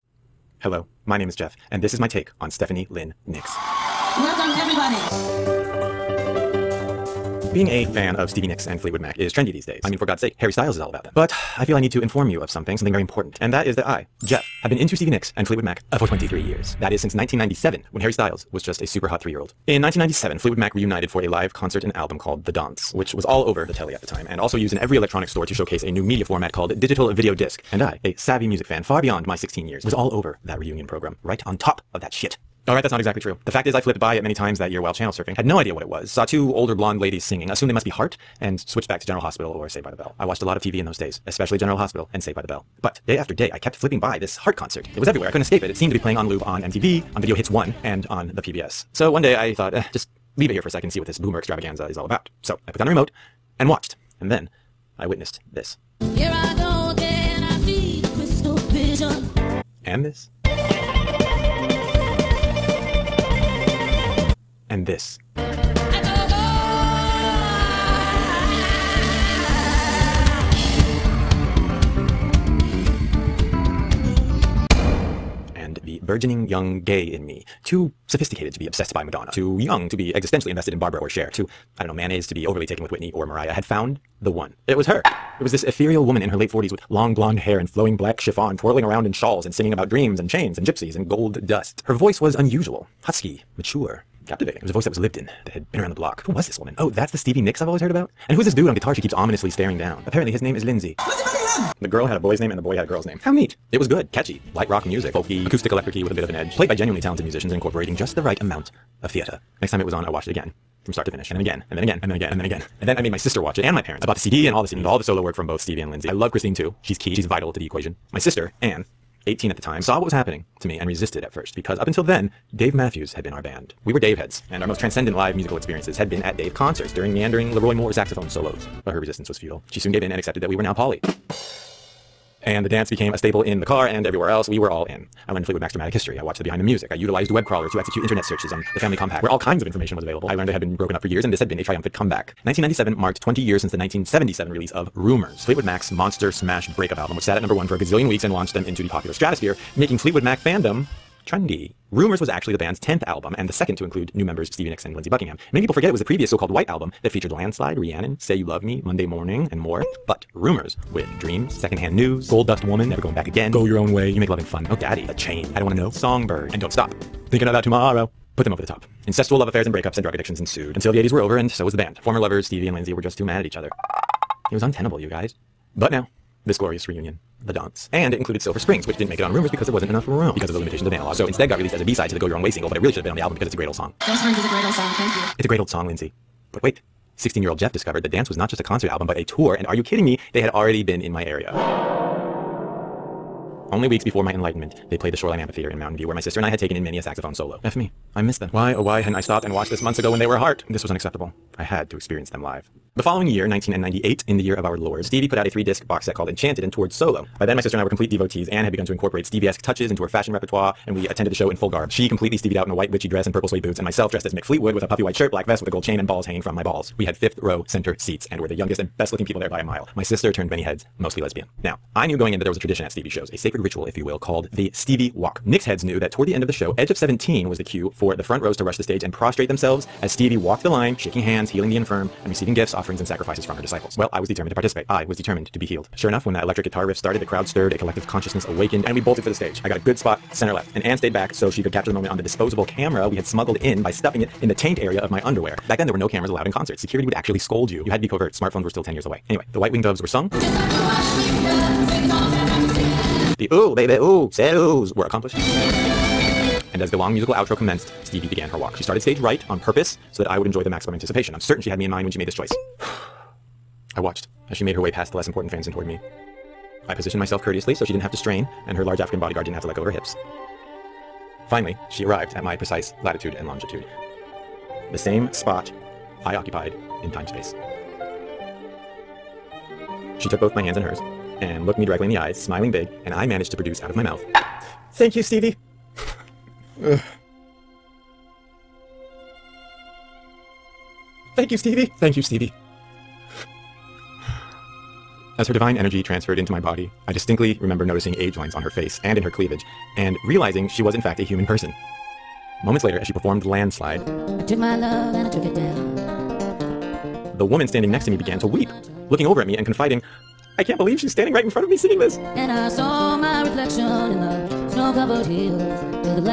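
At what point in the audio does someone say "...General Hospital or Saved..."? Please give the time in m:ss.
0:39.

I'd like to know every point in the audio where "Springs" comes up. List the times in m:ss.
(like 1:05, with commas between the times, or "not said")
2:58, 3:04.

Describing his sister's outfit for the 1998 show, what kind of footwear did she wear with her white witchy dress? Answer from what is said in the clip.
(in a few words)
purple suede boots.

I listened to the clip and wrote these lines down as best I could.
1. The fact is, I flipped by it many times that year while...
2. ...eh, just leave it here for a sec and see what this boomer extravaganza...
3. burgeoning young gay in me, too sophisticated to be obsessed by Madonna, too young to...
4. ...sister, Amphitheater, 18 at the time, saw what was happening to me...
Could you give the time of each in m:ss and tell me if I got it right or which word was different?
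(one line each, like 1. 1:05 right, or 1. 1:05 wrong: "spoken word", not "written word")
1. 0:33 right
2. 0:49 right
3. 1:16 right
4. 1:58 wrong: "Anne", not "Amphitheater".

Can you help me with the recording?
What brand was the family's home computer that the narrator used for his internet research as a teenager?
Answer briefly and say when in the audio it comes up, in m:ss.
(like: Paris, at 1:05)
Compaq, at 2:18.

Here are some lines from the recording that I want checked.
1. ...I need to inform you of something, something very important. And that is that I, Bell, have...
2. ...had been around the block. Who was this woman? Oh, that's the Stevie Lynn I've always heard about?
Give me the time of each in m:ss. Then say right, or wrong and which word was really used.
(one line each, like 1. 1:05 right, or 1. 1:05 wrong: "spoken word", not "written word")
1. 0:11 wrong: "Jeff", not "Bell"
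2. 1:35 wrong: "Nicks", not "Lynn".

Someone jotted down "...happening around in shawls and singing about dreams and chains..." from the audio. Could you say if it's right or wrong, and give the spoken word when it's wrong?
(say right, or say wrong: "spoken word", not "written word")
wrong: "twirling", not "happening".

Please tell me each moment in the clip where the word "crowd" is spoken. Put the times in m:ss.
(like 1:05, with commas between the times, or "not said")
3:57.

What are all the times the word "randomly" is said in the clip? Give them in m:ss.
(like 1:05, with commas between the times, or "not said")
not said.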